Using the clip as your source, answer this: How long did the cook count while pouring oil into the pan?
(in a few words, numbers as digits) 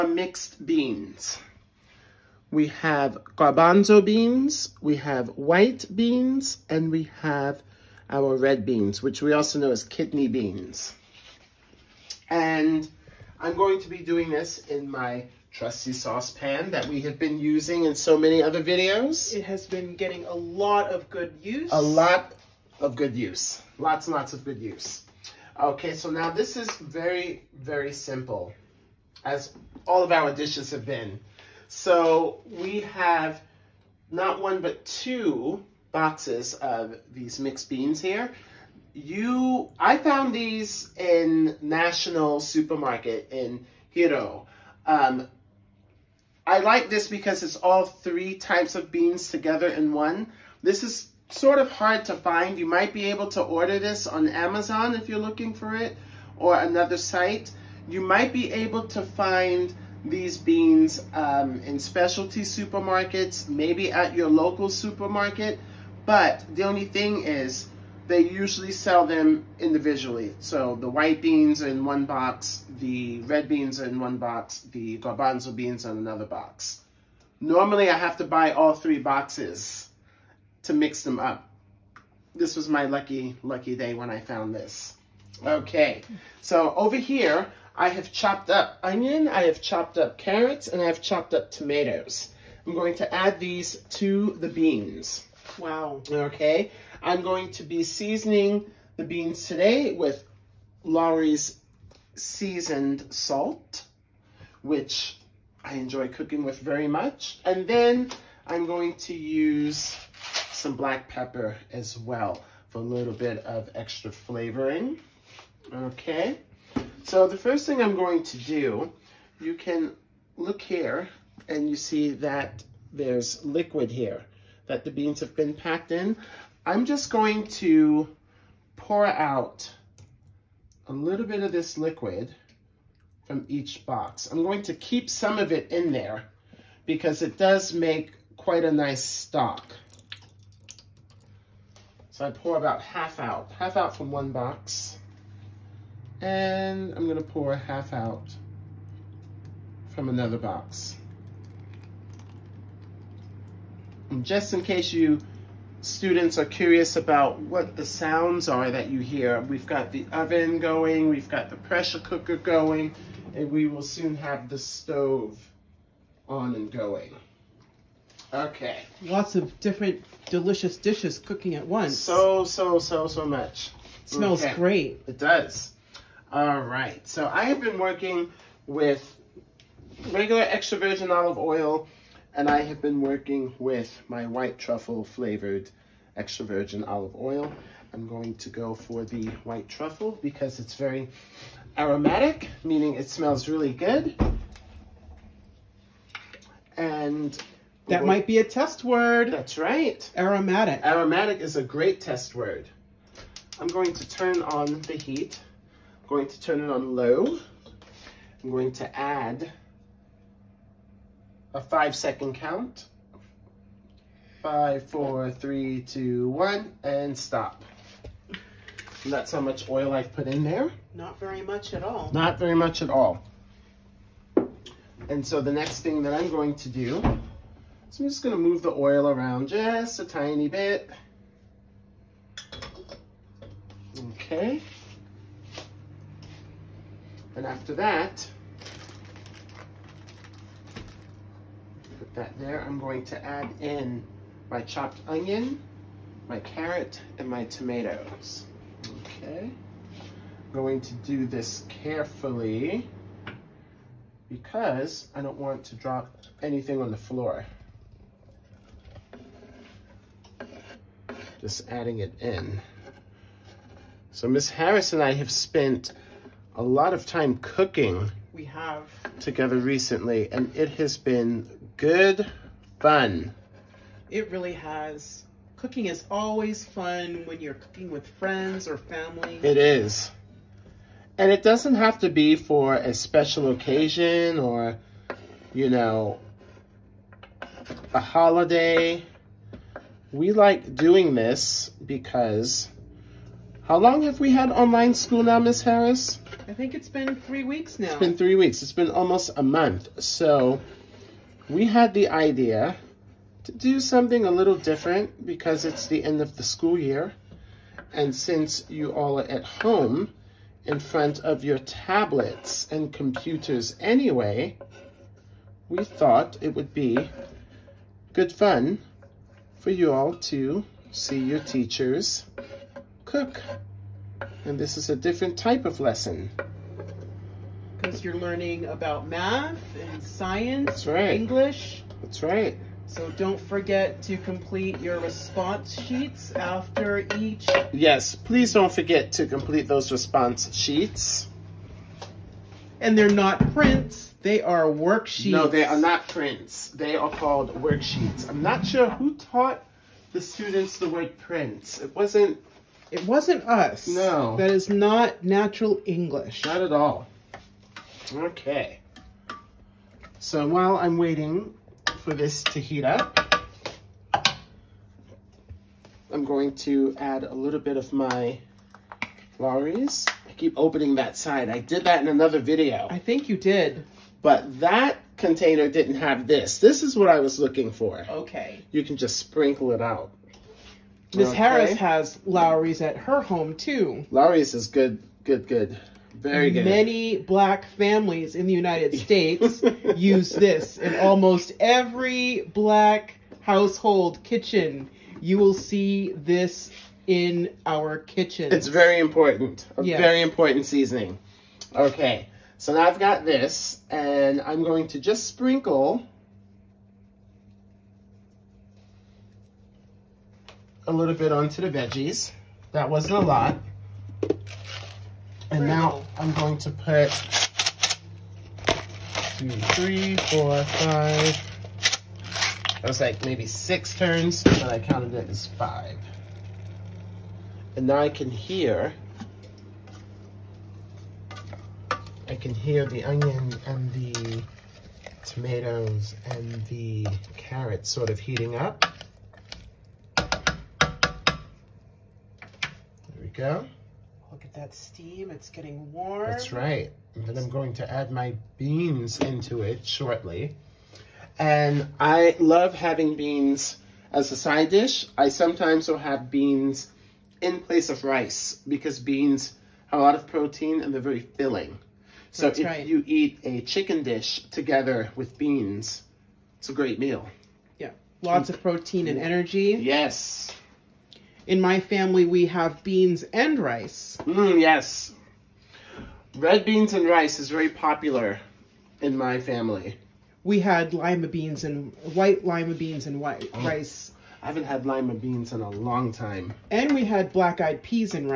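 5 seconds.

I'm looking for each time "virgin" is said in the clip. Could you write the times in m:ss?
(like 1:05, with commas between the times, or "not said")
3:00, 3:06.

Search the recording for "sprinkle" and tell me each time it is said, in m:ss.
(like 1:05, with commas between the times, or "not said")
6:19, 6:45.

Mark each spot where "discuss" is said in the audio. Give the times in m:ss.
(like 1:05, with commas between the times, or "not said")
not said.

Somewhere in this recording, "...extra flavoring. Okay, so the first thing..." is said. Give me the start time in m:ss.
1:53.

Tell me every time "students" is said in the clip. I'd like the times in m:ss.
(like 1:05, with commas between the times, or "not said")
2:35, 5:50.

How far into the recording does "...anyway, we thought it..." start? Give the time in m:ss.
5:13.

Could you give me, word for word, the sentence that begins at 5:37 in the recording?
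Yes, please don't forget to complete those response sheets.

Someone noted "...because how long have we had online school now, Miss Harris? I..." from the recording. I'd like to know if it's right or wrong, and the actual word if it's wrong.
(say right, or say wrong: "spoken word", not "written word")
right.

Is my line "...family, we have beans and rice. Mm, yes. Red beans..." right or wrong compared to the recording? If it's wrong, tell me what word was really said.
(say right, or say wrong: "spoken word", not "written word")
right.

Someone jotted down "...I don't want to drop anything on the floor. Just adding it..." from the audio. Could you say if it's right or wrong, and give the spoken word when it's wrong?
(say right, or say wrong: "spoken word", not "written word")
right.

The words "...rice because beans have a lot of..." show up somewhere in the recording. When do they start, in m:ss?
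7:38.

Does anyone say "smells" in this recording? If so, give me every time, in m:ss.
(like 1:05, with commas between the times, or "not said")
2:54, 3:13.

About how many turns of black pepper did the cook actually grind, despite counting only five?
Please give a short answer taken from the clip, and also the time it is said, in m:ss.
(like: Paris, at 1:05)
6, at 7:03.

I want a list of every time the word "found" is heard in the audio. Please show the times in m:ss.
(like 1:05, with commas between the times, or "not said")
0:39, 1:24.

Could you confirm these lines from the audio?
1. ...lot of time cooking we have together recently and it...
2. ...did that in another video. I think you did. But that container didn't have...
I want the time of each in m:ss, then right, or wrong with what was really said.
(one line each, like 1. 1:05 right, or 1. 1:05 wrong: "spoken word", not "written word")
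1. 4:26 right
2. 6:11 right.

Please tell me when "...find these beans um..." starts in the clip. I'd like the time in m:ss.
0:59.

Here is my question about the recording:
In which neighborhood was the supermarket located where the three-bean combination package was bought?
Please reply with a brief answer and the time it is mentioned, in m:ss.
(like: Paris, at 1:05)
Hiroo, at 0:43.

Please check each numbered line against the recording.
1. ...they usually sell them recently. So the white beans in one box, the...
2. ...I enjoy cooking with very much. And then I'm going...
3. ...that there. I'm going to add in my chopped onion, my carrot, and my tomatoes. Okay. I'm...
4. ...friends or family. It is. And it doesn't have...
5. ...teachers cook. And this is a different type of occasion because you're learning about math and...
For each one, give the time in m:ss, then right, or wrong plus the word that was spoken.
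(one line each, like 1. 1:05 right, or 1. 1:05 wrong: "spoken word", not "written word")
1. 1:08 wrong: "individually", not "recently"
2. 1:45 right
3. 4:02 right
4. 4:38 right
5. 5:21 wrong: "lesson", not "occasion".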